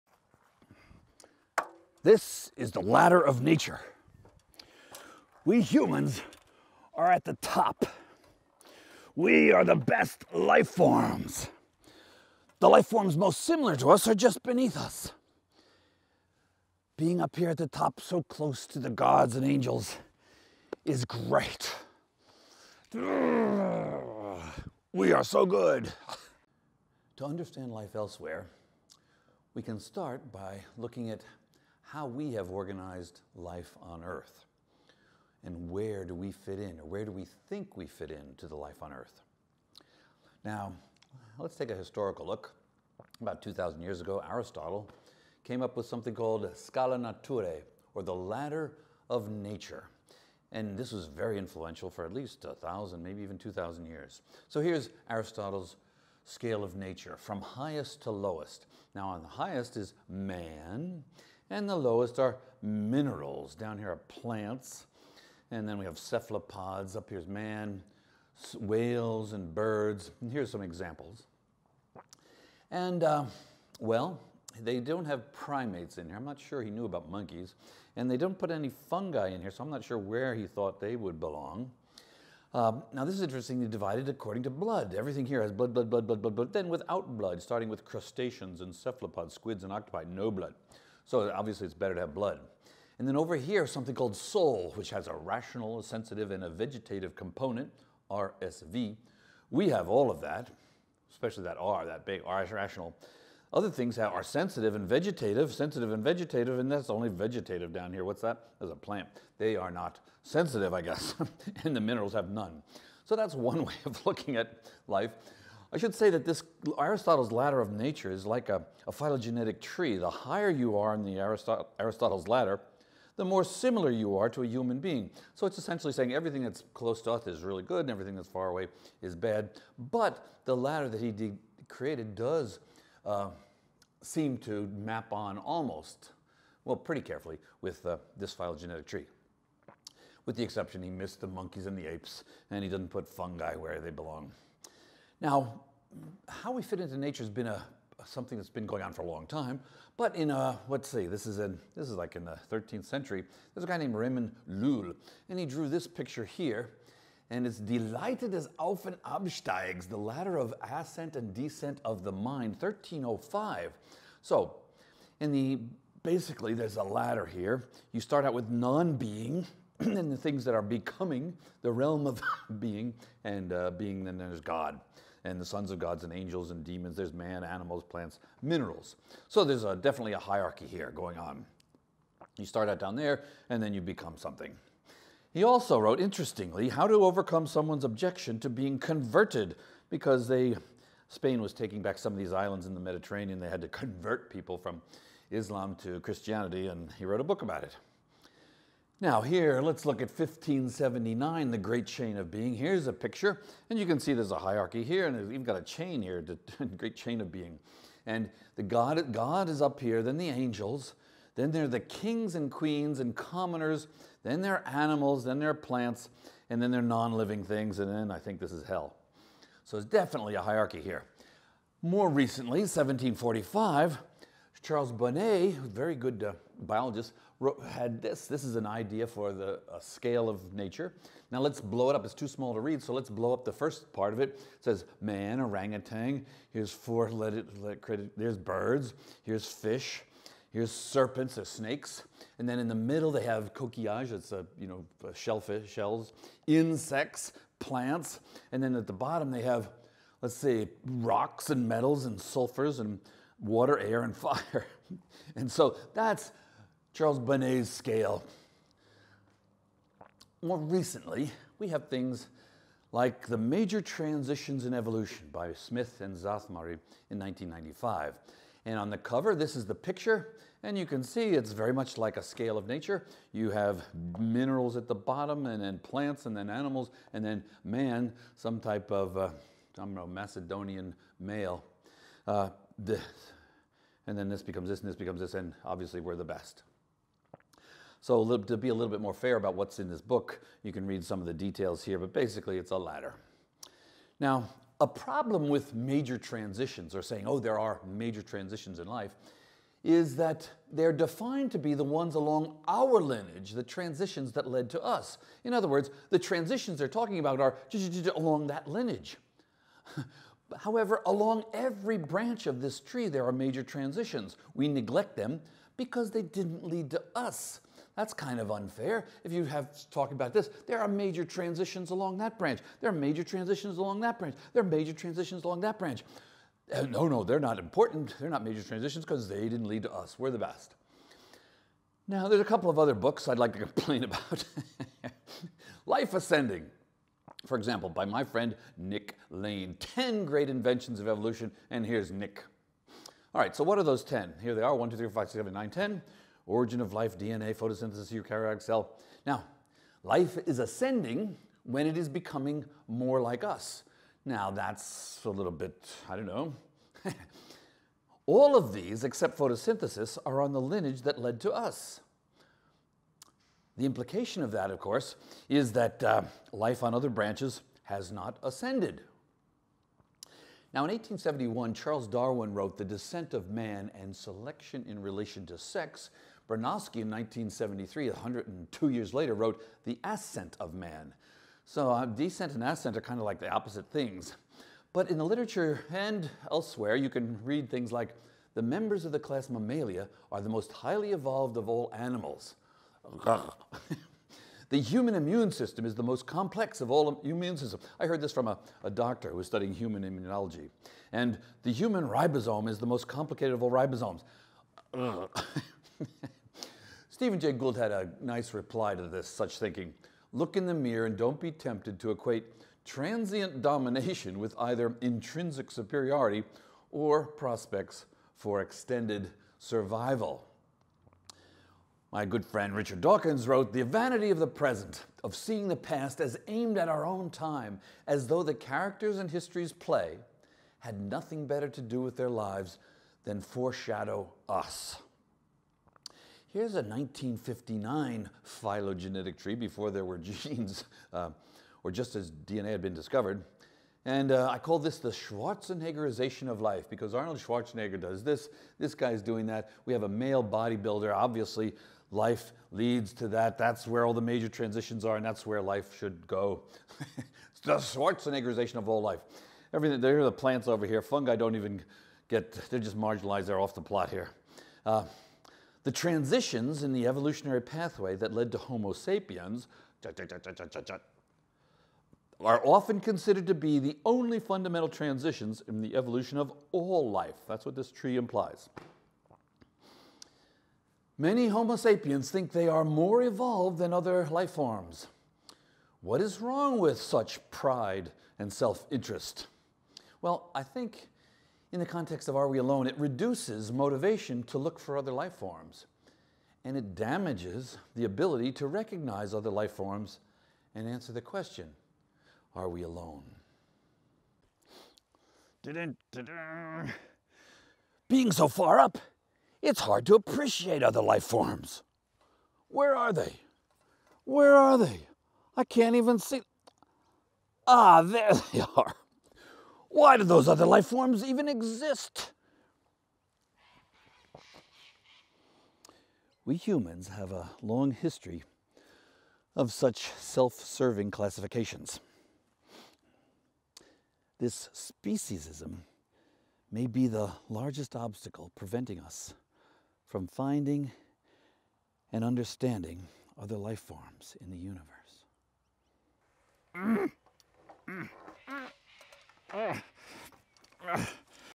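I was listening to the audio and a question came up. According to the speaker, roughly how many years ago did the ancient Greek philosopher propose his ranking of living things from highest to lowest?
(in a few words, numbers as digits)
2,000.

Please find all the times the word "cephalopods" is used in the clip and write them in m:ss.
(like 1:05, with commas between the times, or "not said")
1:05, 1:28.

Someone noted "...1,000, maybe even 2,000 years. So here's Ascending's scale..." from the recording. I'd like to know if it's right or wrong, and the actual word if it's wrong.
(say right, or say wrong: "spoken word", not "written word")
wrong: "Aristotle", not "Ascending".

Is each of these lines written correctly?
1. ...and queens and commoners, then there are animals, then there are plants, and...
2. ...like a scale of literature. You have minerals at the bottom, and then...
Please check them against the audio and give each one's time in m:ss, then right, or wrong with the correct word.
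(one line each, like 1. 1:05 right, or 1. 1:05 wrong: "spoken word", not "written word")
1. 3:32 right
2. 4:31 wrong: "nature", not "literature".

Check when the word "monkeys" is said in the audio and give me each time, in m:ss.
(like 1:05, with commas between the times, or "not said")
1:17, 2:21.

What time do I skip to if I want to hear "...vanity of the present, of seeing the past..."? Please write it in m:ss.
7:03.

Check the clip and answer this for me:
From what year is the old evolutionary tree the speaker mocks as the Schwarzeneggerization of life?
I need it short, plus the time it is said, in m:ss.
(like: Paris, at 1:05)
1959, at 7:16.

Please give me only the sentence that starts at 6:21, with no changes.
So, uh, descent and ascent are kind of like the opposite things.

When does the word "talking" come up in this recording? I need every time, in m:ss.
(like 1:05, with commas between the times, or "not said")
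5:06, 5:19.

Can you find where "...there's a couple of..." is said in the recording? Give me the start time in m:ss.
5:32.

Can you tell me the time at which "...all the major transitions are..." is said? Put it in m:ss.
7:34.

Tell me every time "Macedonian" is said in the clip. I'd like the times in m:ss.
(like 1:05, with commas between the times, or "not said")
4:40.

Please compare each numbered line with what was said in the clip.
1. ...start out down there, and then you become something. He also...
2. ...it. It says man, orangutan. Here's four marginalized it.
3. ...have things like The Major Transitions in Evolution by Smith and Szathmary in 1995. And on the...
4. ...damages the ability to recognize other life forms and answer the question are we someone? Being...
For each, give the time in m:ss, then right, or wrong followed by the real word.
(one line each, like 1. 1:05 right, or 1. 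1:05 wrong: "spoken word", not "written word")
1. 3:02 right
2. 3:54 wrong: "legged", not "marginalized"
3. 4:21 right
4. 8:16 wrong: "alone", not "someone".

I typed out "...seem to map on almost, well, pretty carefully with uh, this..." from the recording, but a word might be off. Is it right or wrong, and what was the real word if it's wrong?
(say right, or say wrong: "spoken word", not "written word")
right.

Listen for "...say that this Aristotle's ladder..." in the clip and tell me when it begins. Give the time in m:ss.
1:55.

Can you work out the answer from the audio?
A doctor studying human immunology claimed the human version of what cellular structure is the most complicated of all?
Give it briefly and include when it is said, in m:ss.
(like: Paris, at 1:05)
Ribosome, at 6:42.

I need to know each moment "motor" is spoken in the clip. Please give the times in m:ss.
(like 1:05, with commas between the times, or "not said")
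not said.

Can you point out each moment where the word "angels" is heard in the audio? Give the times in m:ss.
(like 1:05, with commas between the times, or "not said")
0:19, 2:56, 3:30.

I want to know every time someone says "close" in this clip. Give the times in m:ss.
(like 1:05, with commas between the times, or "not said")
0:18, 2:06.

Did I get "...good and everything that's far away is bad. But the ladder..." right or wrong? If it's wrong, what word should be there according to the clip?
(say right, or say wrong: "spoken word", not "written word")
right.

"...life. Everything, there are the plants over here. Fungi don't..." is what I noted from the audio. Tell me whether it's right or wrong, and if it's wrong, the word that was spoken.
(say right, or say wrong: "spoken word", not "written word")
right.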